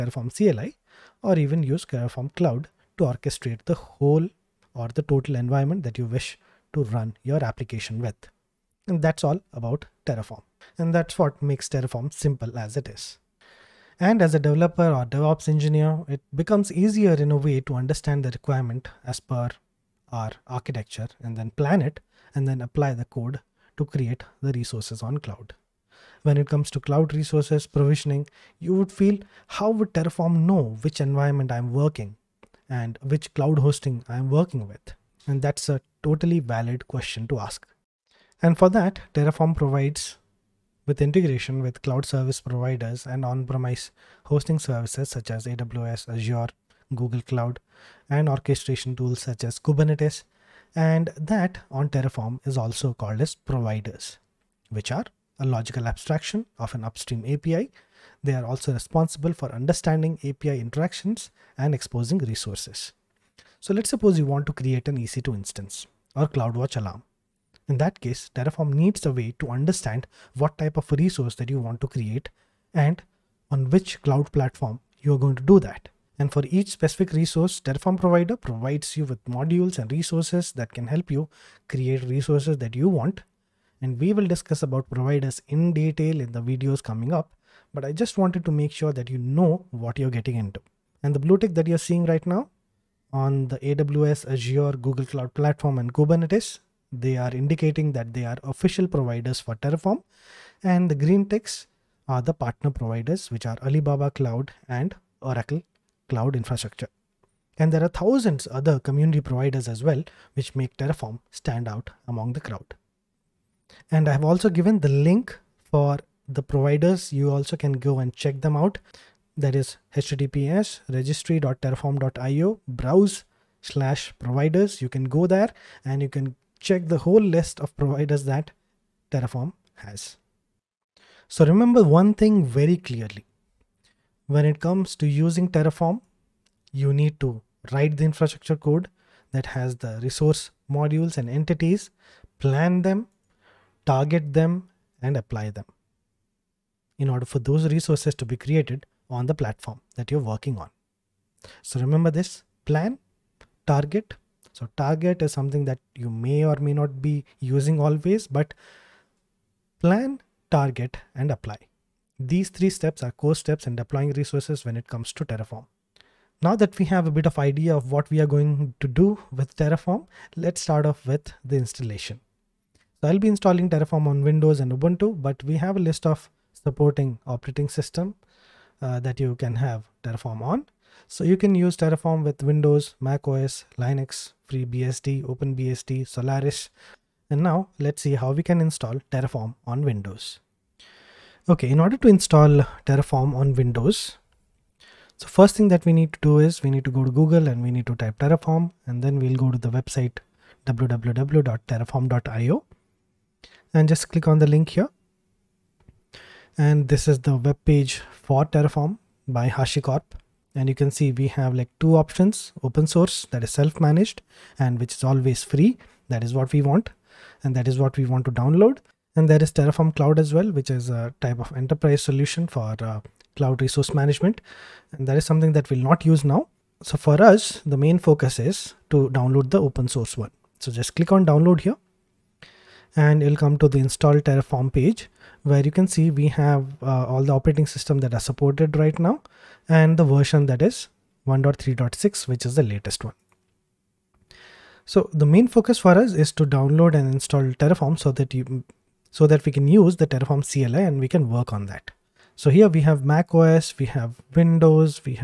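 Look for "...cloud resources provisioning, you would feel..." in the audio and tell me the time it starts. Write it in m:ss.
0:26.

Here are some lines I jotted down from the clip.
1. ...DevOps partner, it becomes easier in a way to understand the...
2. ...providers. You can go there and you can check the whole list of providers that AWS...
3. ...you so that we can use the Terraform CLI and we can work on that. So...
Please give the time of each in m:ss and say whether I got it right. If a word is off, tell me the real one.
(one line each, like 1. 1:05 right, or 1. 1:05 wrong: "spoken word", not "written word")
1. 0:15 wrong: "engineer", not "partner"
2. 2:04 wrong: "Terraform", not "AWS"
3. 4:08 right.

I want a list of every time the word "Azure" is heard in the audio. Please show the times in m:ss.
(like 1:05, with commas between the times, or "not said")
0:46, 1:34.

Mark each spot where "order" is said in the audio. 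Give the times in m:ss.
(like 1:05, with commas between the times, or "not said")
2:27, 3:11.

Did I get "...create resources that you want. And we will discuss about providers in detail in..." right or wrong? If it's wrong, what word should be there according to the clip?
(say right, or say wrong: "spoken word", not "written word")
right.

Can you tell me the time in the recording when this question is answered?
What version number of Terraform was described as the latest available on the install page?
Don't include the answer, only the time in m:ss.
4:01.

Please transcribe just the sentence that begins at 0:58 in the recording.
They are also responsible for understanding API interactions and exposing resources.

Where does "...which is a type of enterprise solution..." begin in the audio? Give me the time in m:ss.
3:40.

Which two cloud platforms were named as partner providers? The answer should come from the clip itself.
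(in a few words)
Alibaba Cloud and Oracle Cloud Infrastructure.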